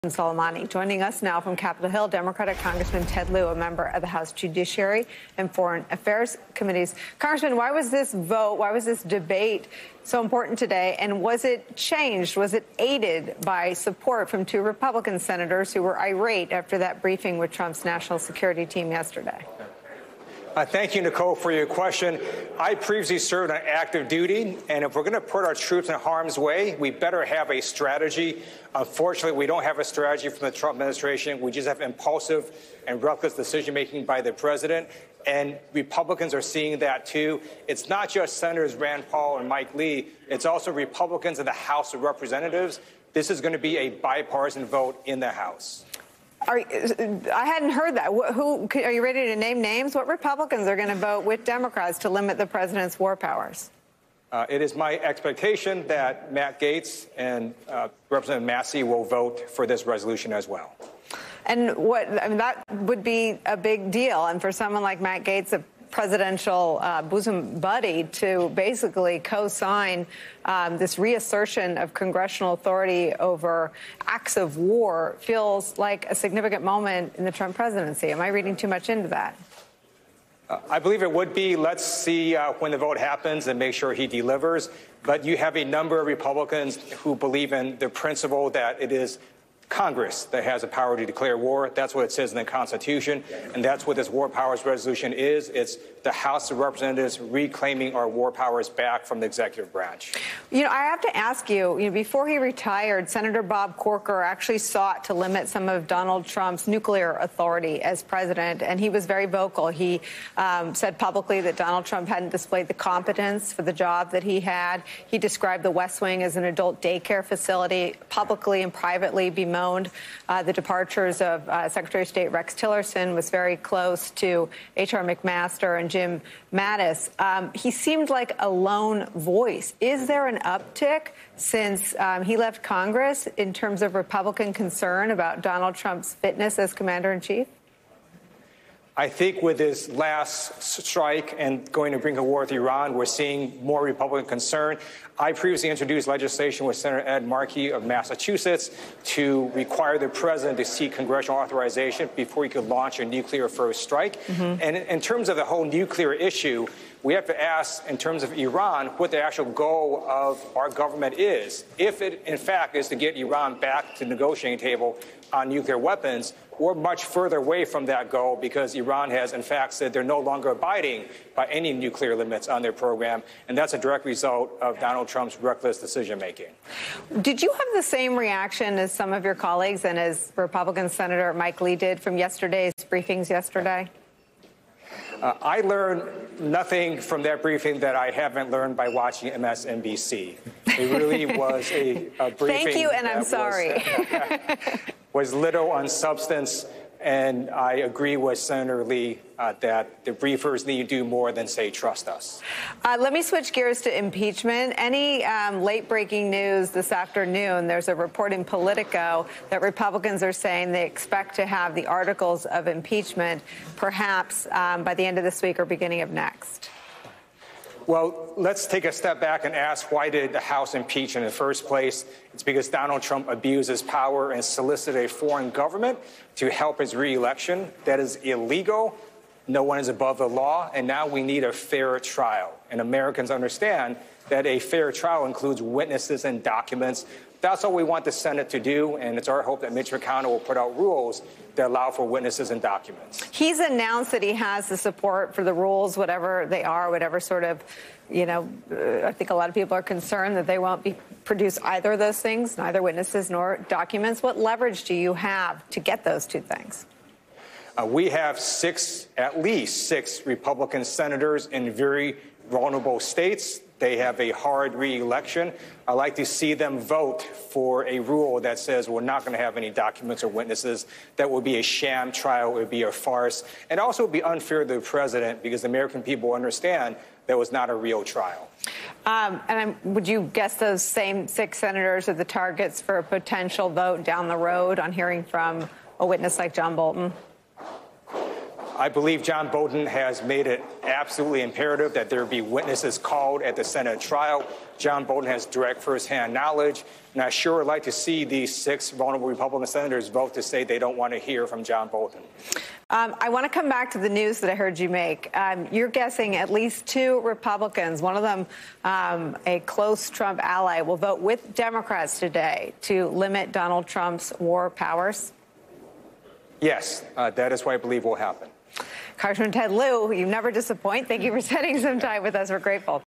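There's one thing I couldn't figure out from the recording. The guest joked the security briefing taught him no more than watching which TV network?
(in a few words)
MSNBC.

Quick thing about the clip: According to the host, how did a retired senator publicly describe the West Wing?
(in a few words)
adult daycare facility.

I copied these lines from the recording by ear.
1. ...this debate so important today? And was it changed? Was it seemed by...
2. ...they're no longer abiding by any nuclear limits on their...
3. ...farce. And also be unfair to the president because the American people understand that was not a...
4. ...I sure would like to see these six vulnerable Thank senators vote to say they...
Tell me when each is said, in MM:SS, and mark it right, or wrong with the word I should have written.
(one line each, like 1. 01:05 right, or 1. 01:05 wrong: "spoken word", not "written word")
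1. 00:08 wrong: "aided", not "seemed"
2. 02:49 right
3. 04:32 right
4. 04:57 wrong: "Republican", not "Thank".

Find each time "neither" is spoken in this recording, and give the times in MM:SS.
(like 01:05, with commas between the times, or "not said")
04:12.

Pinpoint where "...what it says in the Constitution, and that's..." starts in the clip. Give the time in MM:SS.
01:31.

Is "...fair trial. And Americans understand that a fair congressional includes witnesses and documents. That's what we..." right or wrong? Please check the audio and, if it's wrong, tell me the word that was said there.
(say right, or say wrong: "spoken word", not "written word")
wrong: "trial", not "congressional".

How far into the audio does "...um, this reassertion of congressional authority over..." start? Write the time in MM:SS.
01:10.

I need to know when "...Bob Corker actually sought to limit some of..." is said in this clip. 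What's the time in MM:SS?
01:43.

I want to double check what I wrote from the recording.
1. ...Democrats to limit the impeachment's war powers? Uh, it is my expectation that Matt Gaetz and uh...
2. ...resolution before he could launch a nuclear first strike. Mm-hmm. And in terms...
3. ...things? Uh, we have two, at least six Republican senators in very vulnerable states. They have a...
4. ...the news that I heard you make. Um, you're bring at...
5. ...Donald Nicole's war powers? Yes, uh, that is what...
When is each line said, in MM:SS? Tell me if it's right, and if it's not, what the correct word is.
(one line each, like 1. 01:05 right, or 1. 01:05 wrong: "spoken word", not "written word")
1. 00:51 wrong: "president", not "impeachment"
2. 02:31 wrong: "authorization", not "resolution"
3. 04:16 wrong: "six", not "two"
4. 05:03 wrong: "guessing", not "bring"
5. 05:13 wrong: "Trump", not "Nicole".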